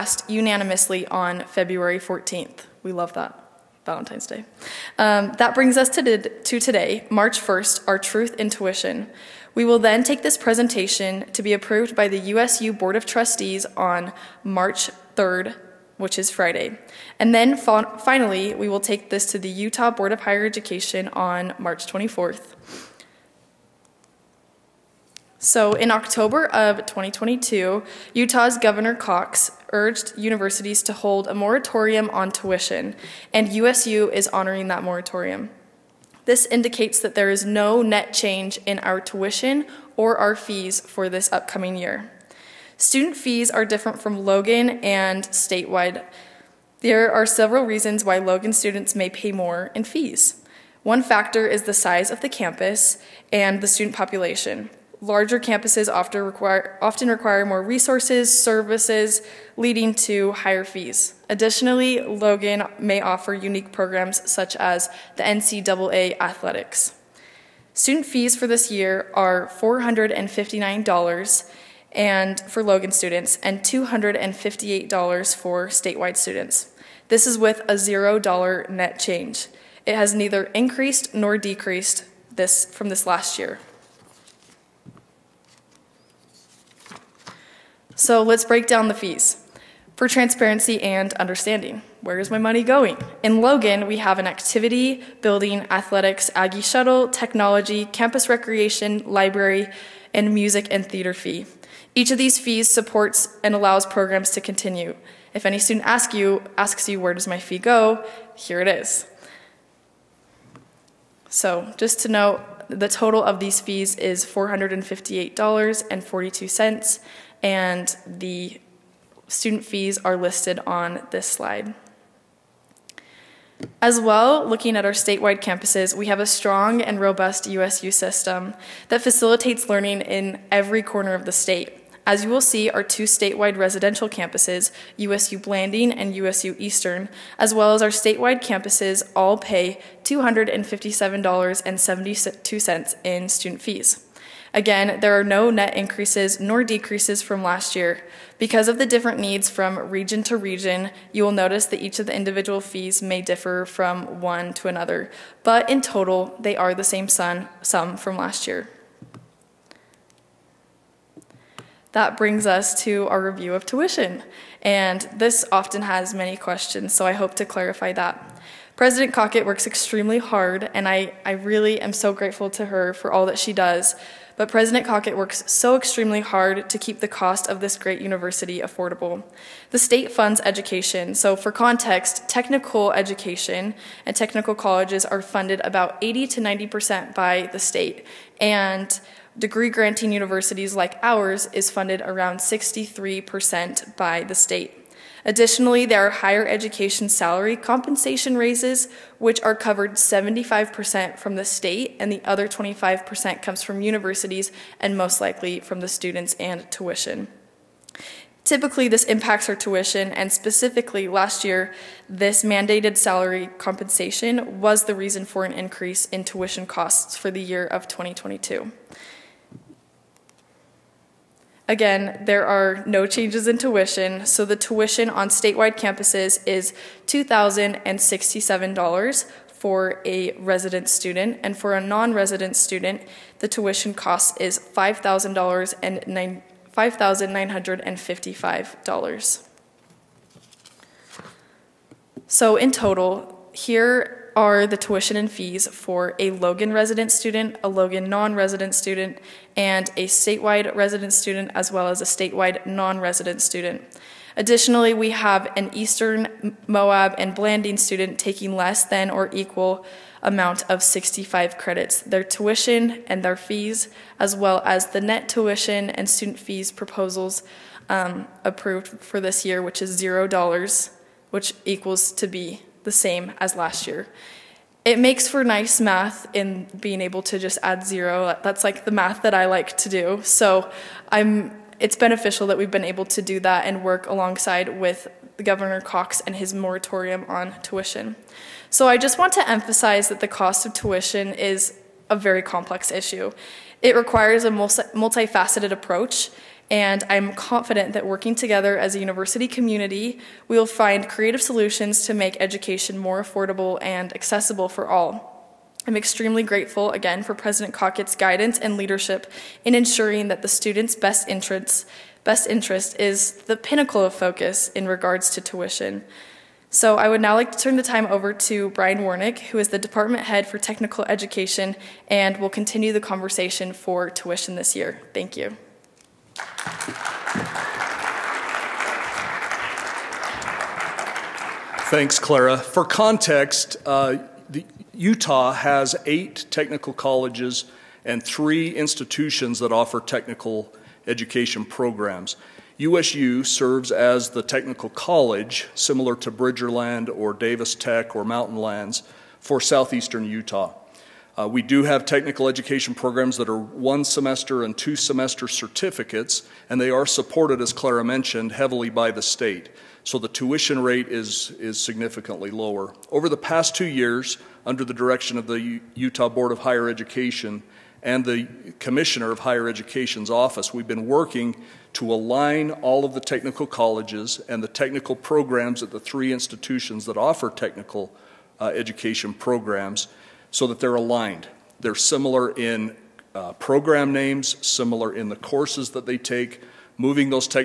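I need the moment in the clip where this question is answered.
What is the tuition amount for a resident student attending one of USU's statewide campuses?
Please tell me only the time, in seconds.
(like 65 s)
227 s.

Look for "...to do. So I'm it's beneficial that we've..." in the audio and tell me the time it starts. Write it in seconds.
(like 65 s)
279 s.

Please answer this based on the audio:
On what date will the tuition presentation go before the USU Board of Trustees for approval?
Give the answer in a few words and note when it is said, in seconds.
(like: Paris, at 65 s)
March 3rd, at 14 s.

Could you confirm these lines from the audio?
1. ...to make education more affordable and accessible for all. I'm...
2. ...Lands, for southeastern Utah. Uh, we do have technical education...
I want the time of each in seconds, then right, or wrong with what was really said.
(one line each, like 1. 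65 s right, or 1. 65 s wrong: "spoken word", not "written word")
1. 302 s right
2. 348 s right.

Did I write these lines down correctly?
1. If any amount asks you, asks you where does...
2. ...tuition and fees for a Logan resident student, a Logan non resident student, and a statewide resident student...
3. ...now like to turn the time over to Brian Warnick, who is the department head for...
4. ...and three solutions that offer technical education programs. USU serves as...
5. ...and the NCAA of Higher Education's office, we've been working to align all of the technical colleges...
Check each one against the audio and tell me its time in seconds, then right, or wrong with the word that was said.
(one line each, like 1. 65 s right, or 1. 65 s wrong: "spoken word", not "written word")
1. 105 s wrong: "student", not "amount"
2. 244 s right
3. 317 s right
4. 338 s wrong: "institutions", not "solutions"
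5. 368 s wrong: "Commissioner", not "NCAA".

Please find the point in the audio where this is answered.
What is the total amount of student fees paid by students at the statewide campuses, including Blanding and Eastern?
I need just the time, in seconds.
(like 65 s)
140 s.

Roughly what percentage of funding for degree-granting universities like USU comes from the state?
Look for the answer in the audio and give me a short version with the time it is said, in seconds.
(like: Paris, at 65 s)
63%, at 192 s.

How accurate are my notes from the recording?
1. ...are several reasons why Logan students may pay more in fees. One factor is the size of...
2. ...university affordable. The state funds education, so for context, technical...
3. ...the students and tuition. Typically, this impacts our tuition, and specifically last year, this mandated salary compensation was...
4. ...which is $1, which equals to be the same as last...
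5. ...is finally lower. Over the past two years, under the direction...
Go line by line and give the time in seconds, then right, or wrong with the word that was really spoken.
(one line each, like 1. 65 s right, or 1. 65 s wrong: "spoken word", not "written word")
1. 47 s right
2. 178 s right
3. 205 s right
4. 269 s wrong: "0", not "1"
5. 361 s wrong: "significantly", not "finally".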